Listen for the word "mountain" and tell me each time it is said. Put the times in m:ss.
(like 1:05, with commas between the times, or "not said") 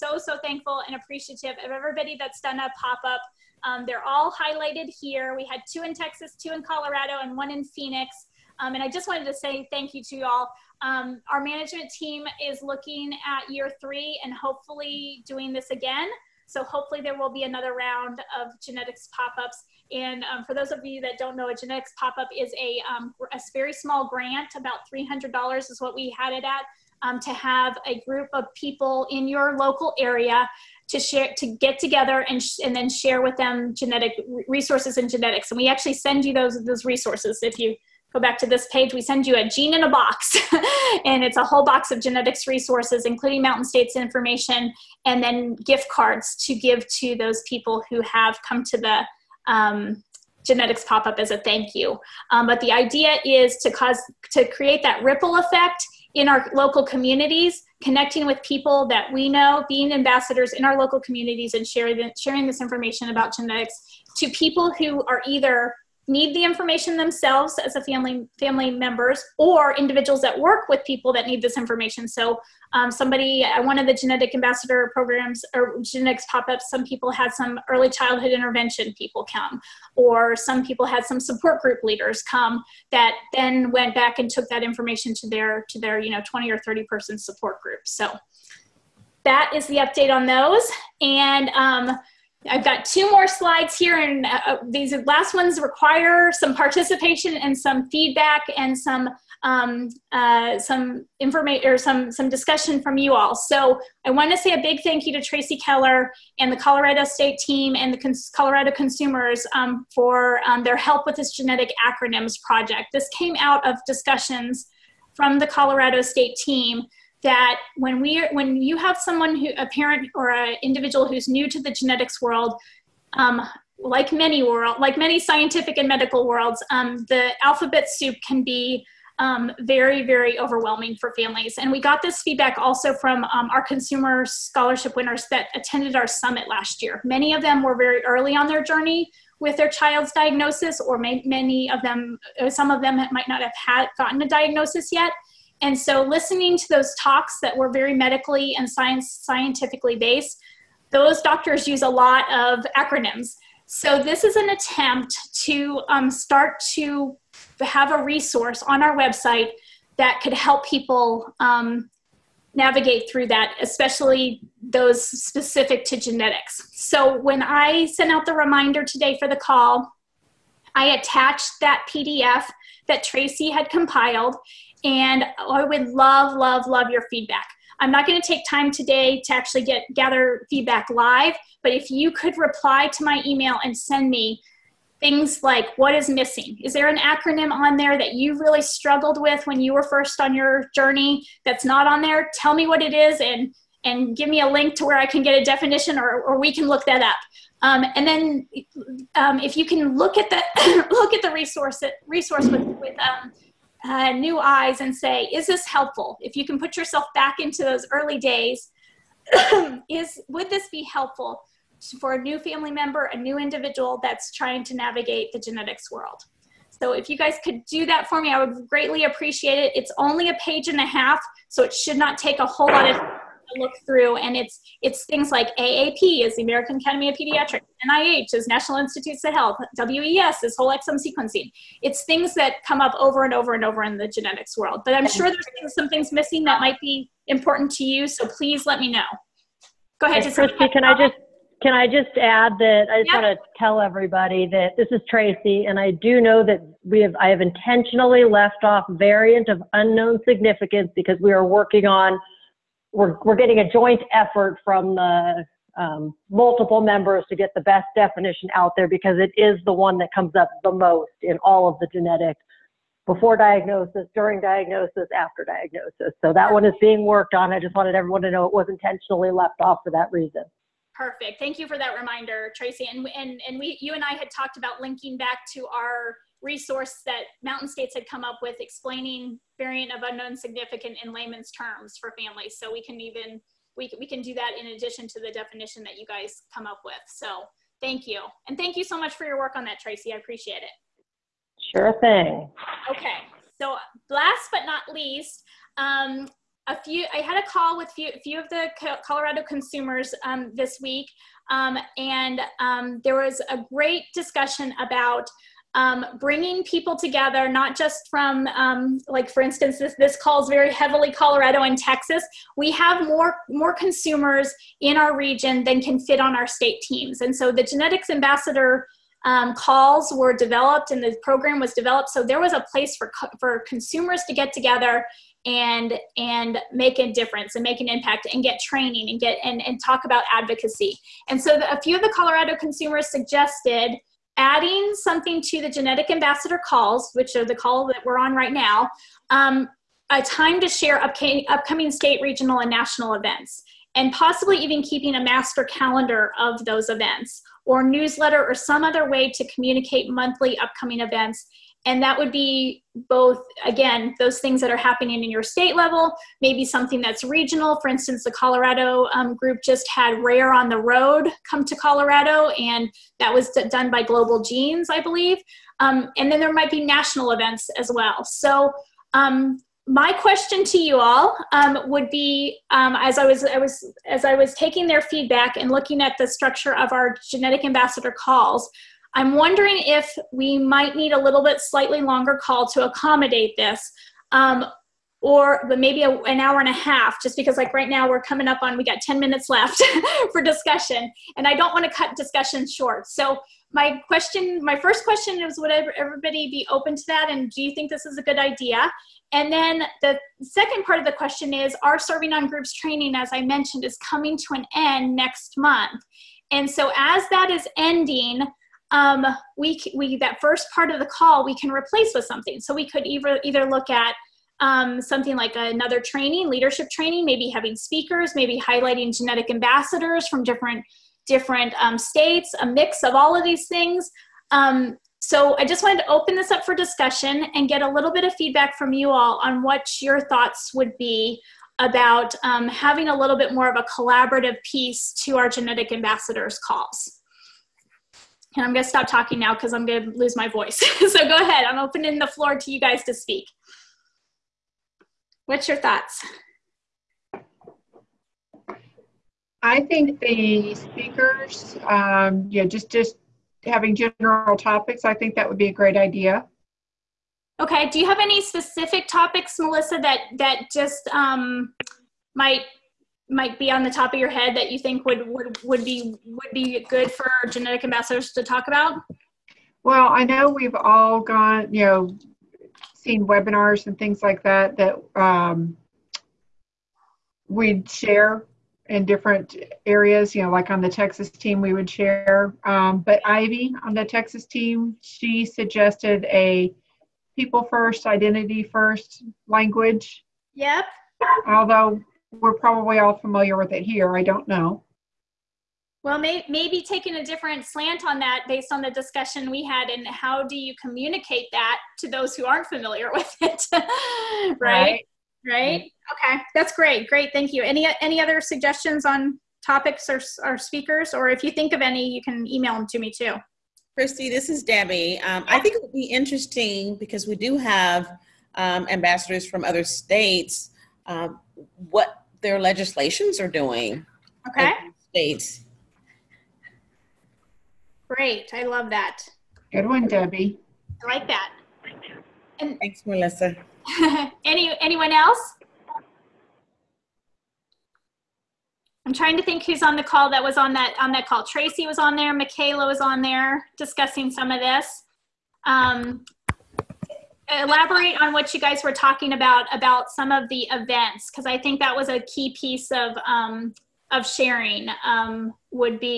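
0:43, 4:37.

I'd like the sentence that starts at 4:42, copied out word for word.
So we can even, we, we can do that in addition to the definition that you guys come up with.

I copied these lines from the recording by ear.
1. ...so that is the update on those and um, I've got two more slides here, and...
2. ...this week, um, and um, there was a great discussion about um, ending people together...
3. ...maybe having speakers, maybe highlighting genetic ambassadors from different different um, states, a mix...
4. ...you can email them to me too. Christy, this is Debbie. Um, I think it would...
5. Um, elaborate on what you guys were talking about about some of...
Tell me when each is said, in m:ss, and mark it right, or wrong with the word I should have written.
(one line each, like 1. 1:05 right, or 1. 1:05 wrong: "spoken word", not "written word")
1. 1:27 right
2. 5:00 wrong: "bringing", not "ending"
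3. 6:57 right
4. 8:32 right
5. 9:05 right.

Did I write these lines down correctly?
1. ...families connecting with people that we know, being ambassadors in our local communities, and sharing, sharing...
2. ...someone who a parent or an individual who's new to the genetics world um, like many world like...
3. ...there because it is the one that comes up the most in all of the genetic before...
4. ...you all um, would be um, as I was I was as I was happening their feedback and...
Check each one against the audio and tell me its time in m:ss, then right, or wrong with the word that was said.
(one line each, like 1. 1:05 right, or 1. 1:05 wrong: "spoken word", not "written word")
1. 0:56 wrong: "communities", not "families"
2. 1:58 right
3. 4:18 right
4. 6:10 wrong: "taking", not "happening".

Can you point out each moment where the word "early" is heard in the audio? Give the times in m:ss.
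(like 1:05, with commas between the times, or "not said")
1:17, 2:18, 3:27.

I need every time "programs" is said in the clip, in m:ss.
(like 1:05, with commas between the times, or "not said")
1:14, 5:21.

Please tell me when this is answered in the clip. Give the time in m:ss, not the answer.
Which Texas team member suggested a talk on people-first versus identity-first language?
8:03.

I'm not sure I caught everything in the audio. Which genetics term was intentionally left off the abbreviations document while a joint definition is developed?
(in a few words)
variant of unknown significance.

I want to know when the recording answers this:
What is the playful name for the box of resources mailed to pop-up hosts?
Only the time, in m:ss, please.
0:39.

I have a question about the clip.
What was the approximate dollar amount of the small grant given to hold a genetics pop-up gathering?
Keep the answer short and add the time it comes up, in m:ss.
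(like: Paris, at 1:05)
$300, at 0:24.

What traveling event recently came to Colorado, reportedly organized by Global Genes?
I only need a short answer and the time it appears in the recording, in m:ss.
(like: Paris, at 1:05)
Rare on the Road, at 6:00.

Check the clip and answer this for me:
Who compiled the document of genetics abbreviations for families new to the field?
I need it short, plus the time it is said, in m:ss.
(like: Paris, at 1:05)
Tracy Keller, at 1:45.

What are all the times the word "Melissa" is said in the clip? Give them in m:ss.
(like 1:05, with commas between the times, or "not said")
7:39, 8:53.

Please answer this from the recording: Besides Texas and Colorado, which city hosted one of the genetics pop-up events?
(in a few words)
Phoenix.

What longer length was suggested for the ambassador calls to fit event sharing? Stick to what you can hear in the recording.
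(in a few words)
an hour and a half.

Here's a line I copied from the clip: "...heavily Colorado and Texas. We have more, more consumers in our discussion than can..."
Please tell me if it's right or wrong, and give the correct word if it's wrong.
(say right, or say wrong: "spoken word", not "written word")
wrong: "region", not "discussion".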